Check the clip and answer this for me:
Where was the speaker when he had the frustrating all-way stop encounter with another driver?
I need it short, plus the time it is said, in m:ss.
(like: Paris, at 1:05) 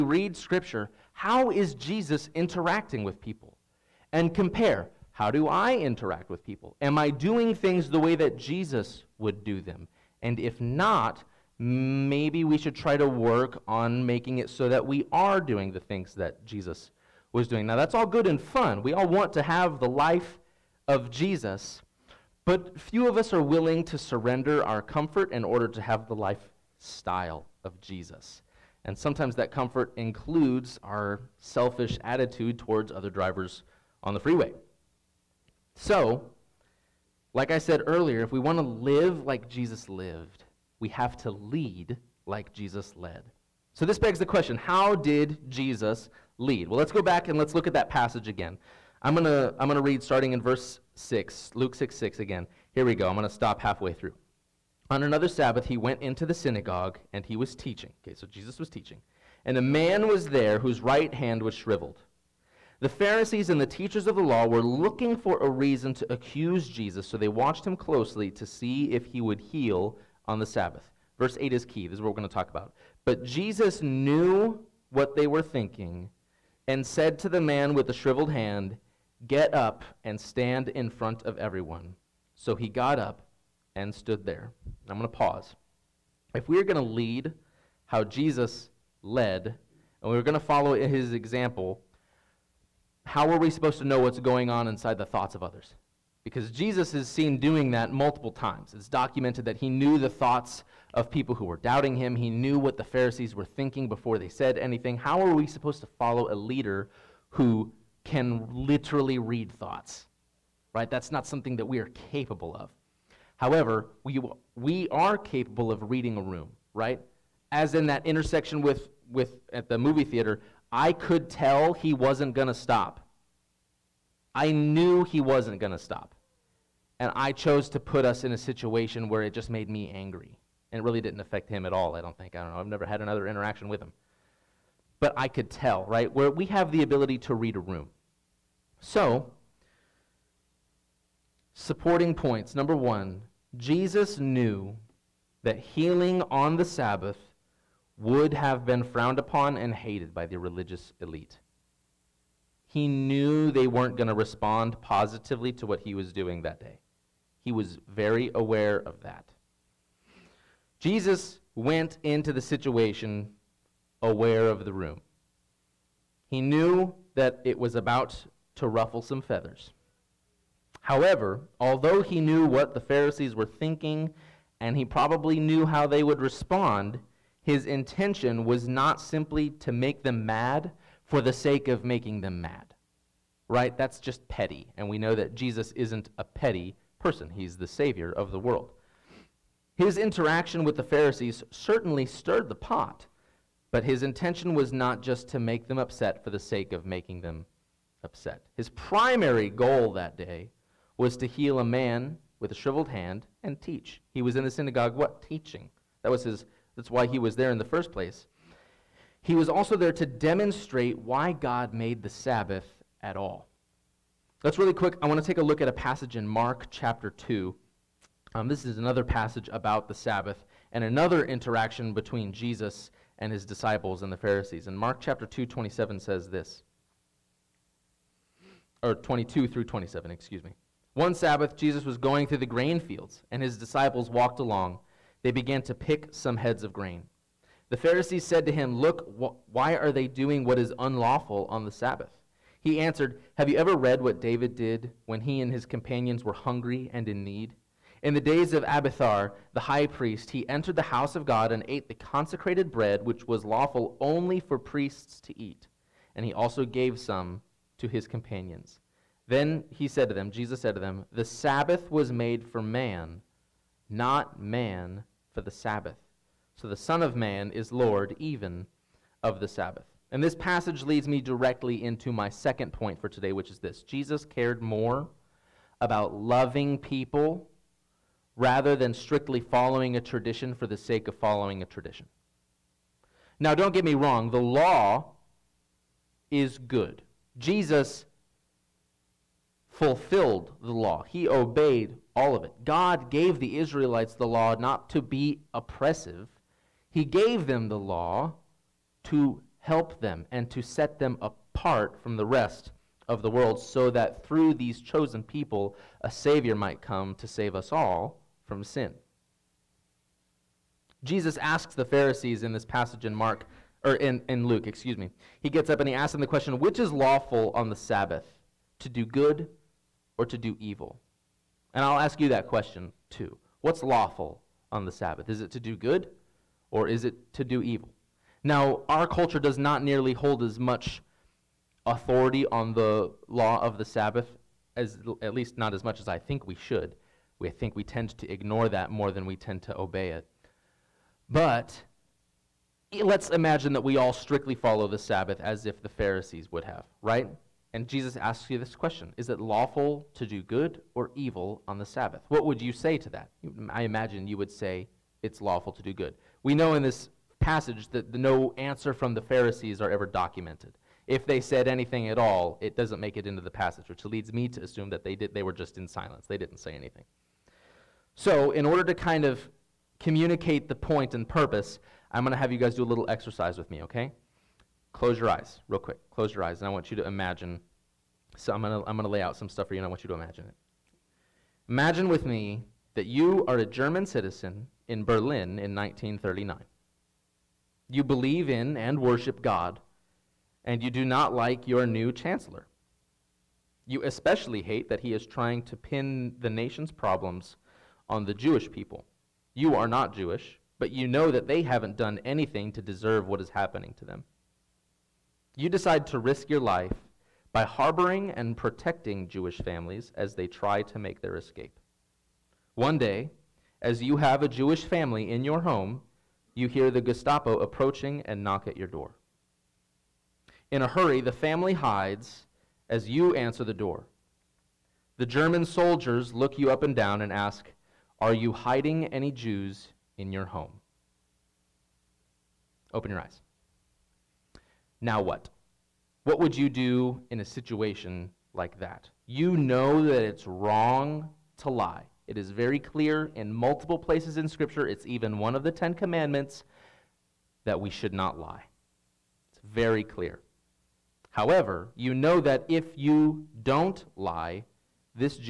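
Movie theater, at 1:59.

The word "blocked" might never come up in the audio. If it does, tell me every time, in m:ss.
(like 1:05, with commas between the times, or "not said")
not said.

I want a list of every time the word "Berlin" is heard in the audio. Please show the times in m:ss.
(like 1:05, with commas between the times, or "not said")
6:25.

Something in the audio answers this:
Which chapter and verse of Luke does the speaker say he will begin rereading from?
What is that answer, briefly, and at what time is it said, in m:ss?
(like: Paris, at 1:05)
Luke 6:6, at 0:51.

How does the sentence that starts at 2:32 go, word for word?
He knew they weren't going to respond positively to what he was doing that day.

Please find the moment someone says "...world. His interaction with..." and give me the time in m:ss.
3:08.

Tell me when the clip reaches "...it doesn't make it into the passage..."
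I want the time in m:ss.
6:02.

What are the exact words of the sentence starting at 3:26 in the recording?
That was his, that's why he was there in the first place.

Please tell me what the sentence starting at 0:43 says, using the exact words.
So, this begs the question how did Jesus lead?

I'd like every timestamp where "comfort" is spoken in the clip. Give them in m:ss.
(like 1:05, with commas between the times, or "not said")
0:24, 0:29.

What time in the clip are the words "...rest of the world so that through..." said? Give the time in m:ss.
5:02.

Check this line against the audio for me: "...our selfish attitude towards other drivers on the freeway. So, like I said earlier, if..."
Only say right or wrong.
right.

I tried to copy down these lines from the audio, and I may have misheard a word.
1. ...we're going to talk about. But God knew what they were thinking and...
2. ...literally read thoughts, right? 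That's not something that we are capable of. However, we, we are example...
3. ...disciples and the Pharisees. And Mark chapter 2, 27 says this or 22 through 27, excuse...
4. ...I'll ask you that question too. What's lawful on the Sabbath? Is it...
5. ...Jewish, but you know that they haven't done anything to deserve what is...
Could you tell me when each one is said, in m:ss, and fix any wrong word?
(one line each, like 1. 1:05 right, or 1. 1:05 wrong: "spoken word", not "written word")
1. 1:12 wrong: "Jesus", not "God"
2. 1:48 wrong: "capable", not "example"
3. 3:43 right
4. 5:21 right
5. 6:40 right.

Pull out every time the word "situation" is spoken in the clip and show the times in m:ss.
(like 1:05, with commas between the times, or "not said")
2:08, 2:42, 7:17.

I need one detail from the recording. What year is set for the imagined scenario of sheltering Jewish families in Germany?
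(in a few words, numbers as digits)
1939.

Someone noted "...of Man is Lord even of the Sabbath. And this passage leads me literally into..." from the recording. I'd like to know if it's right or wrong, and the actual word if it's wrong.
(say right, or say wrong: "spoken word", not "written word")
wrong: "directly", not "literally".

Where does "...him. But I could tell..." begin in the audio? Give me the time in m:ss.
2:13.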